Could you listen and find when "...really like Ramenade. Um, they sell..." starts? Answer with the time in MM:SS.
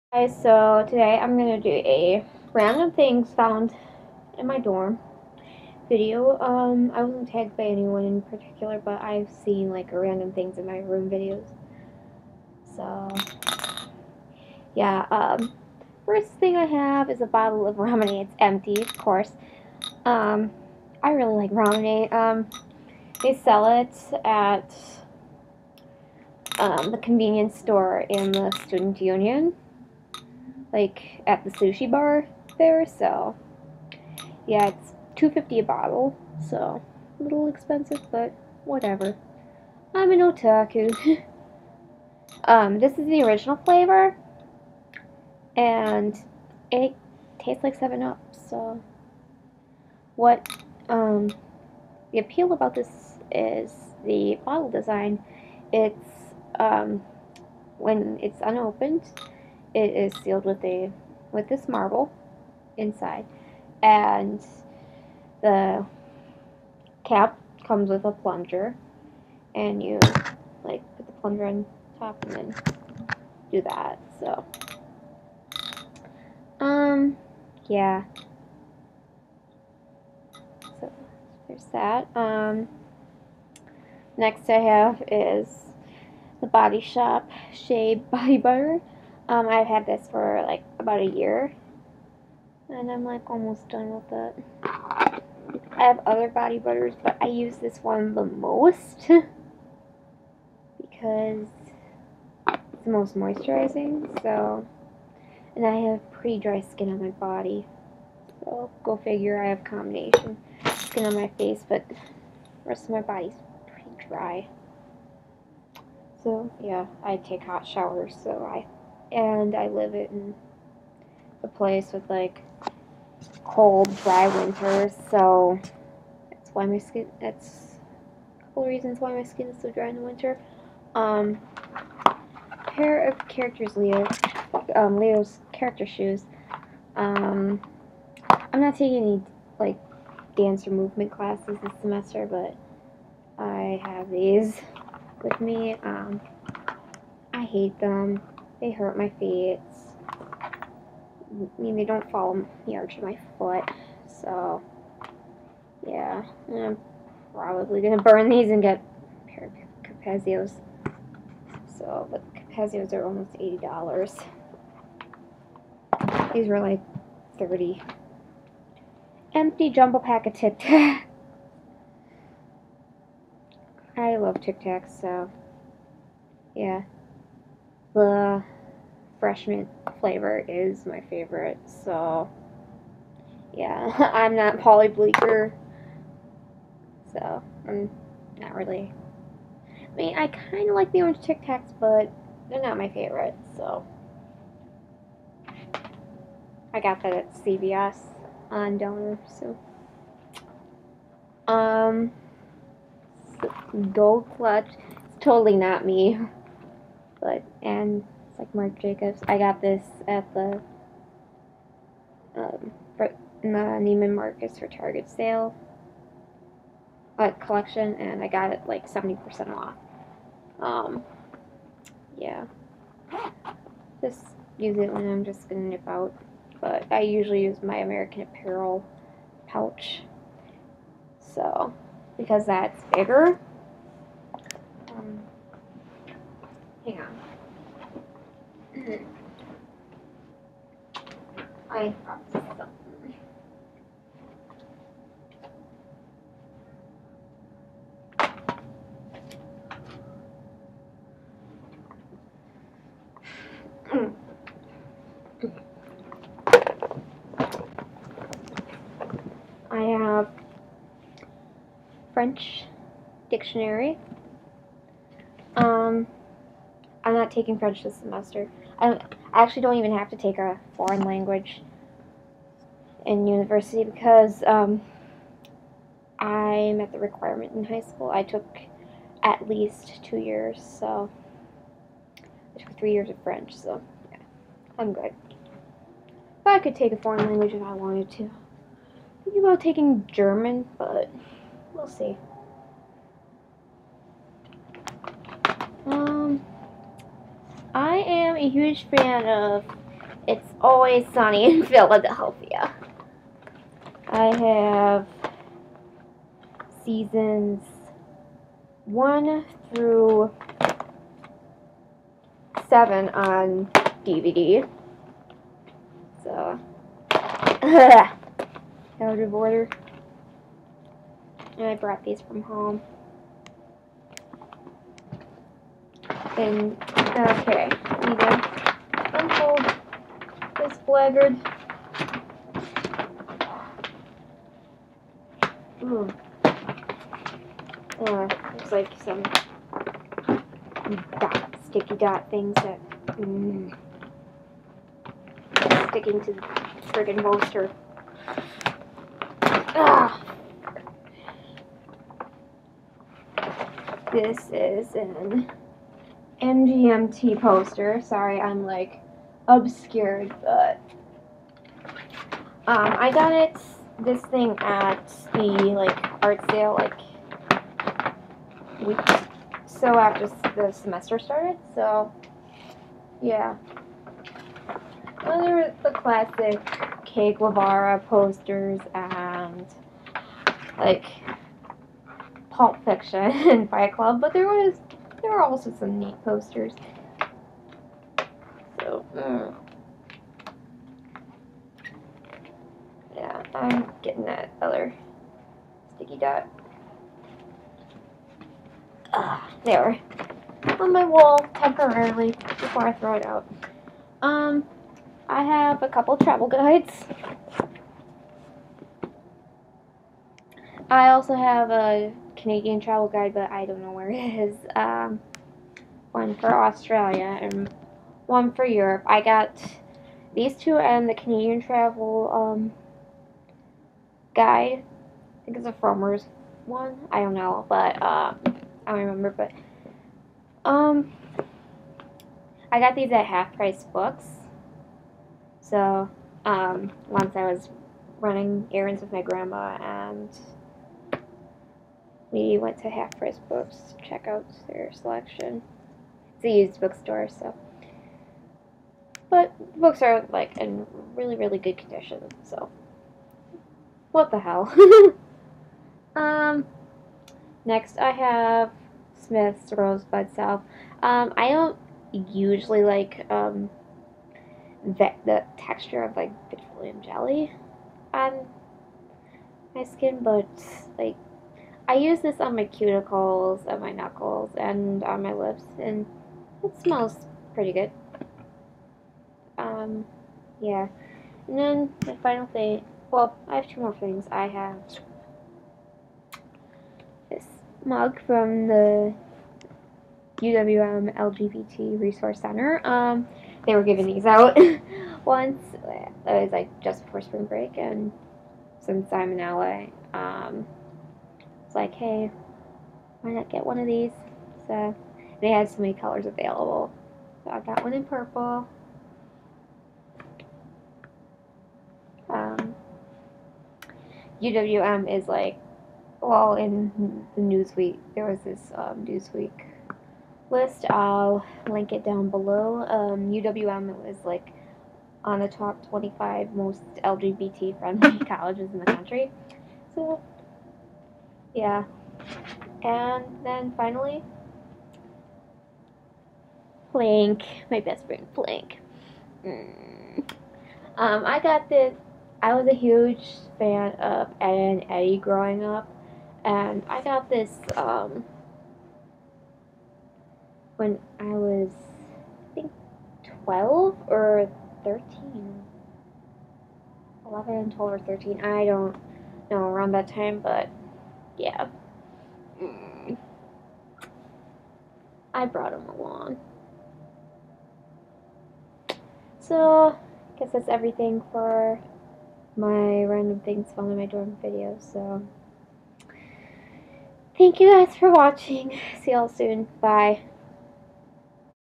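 00:21.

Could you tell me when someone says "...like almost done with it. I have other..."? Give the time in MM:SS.
01:33.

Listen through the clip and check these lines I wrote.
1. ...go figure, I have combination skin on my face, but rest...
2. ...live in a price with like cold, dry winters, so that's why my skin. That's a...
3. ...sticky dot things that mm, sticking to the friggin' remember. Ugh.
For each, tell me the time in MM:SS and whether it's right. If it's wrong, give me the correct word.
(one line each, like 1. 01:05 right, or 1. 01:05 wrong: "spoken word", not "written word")
1. 01:48 right
2. 01:59 wrong: "place", not "price"
3. 05:41 wrong: "bolster", not "remember".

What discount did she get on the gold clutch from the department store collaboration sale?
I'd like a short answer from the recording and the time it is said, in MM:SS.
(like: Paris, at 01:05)
70%, at 03:38.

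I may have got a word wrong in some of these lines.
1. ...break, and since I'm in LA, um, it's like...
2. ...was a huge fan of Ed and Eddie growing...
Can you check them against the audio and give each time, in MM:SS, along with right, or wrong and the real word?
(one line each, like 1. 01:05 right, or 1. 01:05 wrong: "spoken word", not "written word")
1. 08:17 right
2. 09:02 right.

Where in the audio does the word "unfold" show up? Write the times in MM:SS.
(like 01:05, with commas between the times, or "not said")
05:29.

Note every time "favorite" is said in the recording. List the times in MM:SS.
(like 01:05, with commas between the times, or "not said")
03:01, 03:12.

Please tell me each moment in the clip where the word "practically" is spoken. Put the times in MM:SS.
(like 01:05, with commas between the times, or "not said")
not said.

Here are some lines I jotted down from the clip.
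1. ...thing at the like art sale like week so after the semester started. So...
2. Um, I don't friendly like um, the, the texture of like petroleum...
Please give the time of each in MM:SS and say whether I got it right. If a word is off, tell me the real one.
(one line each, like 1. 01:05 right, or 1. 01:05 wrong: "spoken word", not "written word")
1. 06:04 right
2. 07:41 wrong: "usually", not "friendly".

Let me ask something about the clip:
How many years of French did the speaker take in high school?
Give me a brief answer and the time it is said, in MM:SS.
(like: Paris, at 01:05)
3, at 04:42.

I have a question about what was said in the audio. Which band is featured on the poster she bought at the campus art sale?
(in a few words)
MGMT.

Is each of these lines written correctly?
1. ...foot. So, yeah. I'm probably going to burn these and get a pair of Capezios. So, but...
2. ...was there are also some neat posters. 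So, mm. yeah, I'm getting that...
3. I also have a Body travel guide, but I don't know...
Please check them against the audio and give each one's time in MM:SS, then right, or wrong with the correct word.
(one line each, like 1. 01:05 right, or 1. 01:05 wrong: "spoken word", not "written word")
1. 02:33 right
2. 06:24 right
3. 06:50 wrong: "Canadian", not "Body".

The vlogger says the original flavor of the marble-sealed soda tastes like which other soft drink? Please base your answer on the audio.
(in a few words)
Seven Up.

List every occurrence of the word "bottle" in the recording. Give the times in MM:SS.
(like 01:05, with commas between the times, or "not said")
00:17, 00:35, 00:54.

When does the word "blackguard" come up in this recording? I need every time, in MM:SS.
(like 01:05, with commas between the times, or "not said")
05:30.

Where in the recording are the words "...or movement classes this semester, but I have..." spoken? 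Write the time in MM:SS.
02:20.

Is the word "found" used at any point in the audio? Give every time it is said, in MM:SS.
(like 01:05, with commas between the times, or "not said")
00:03, 09:33.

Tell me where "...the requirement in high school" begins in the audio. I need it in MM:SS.
04:36.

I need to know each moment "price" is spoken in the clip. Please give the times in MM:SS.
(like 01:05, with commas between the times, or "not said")
07:13, 07:23.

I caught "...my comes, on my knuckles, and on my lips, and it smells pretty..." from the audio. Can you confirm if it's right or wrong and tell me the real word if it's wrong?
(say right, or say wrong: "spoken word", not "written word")
wrong: "cuticles", not "comes".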